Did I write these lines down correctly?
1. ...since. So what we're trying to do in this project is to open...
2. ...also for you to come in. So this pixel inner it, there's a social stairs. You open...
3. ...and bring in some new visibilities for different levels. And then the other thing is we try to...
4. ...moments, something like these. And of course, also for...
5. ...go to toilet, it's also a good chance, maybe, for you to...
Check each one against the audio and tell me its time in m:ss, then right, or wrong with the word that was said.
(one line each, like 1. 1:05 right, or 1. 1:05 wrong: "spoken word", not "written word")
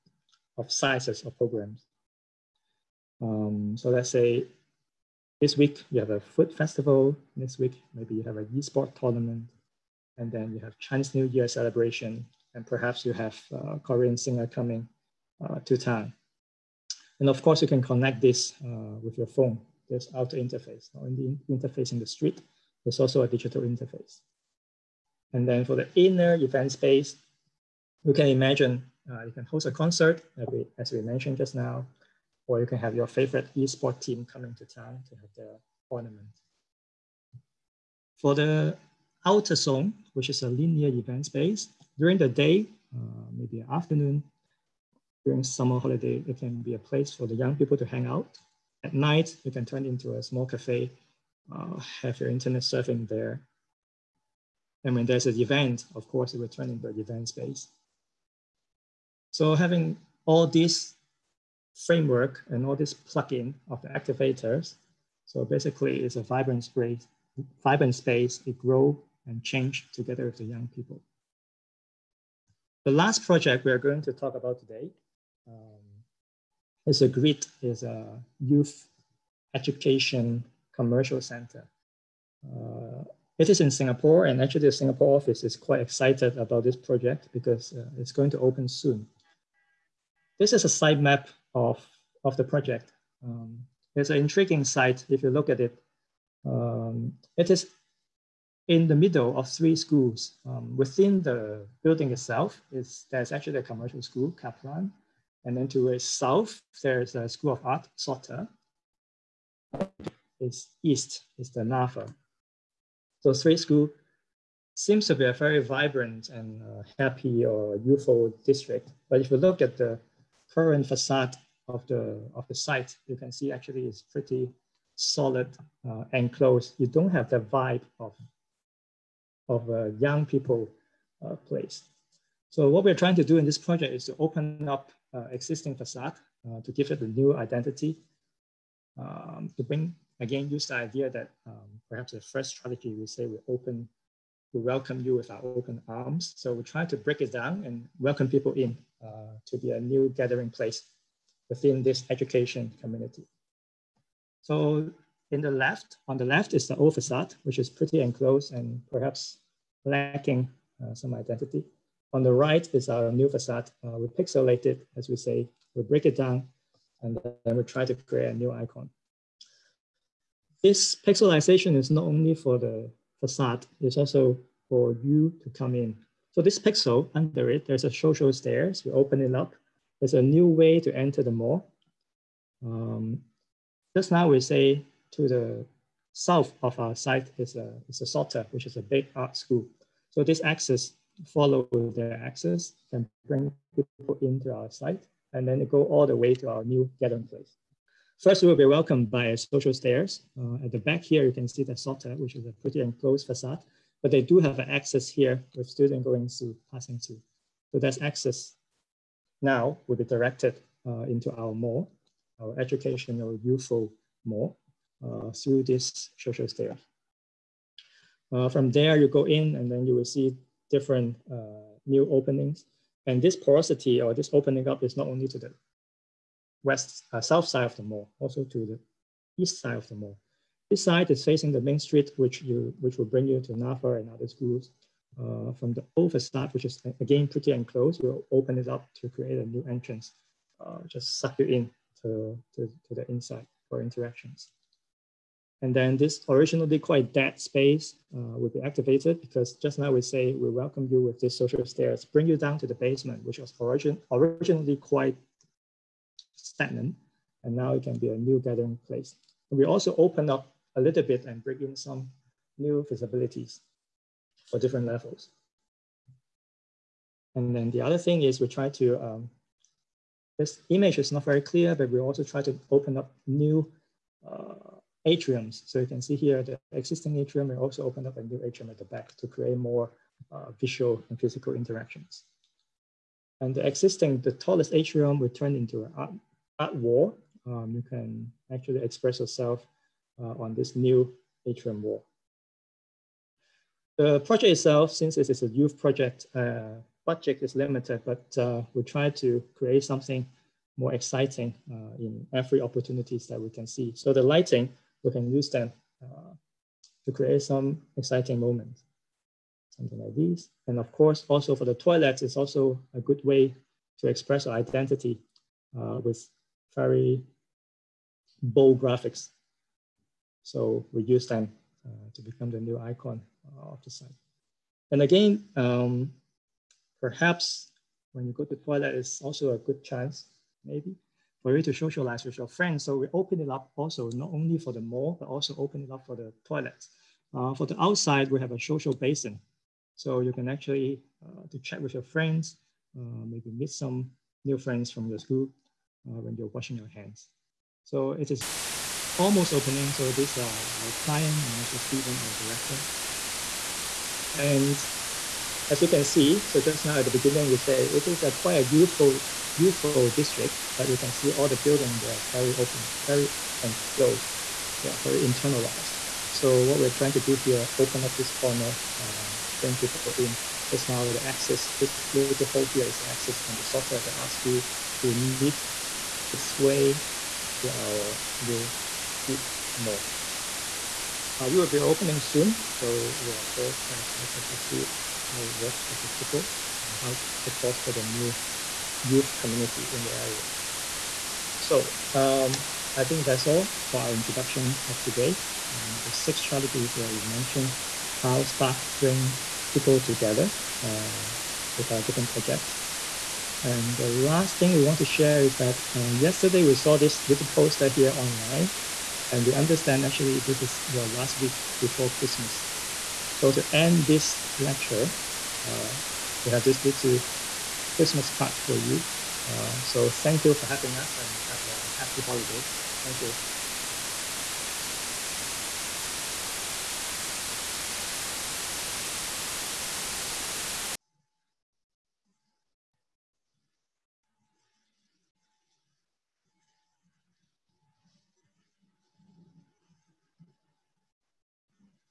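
1. 2:11 wrong: "place", not "since"
2. 2:53 wrong: "under", not "inner"
3. 4:21 right
4. 5:08 right
5. 5:28 right.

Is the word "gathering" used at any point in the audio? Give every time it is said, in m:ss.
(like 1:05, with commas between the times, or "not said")
2:30, 3:16, 4:18.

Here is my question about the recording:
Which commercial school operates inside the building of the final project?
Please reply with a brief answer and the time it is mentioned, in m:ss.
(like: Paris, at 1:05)
Kaplan, at 1:44.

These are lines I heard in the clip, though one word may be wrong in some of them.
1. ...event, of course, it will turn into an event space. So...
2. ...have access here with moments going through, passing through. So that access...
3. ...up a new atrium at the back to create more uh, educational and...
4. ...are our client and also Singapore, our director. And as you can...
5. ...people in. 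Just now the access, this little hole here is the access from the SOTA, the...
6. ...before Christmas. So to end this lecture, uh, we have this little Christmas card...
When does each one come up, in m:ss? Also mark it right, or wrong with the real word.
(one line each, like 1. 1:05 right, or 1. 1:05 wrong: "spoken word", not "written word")
1. 0:55 right
2. 3:24 wrong: "students", not "moments"
3. 4:38 wrong: "visual", not "educational"
4. 5:50 wrong: "Stephen", not "Singapore"
5. 6:09 right
6. 6:51 right.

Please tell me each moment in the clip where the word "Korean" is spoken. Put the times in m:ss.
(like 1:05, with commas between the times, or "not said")
0:13.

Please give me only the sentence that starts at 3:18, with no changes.
First, we will be welcomed by social stairs.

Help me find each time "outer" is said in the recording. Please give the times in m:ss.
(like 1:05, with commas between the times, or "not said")
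0:20, 0:39.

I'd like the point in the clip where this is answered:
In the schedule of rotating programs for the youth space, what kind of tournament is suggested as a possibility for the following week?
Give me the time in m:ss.
0:08.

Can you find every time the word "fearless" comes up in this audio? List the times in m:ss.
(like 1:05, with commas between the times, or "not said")
not said.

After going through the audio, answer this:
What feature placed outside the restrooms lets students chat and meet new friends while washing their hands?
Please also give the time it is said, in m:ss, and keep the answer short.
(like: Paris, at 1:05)
Social basin, at 5:38.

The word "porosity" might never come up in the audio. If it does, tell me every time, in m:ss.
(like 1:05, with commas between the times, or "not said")
3:43.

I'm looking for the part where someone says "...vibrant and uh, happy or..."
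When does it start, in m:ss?
1:55.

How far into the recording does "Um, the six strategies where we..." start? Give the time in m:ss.
6:35.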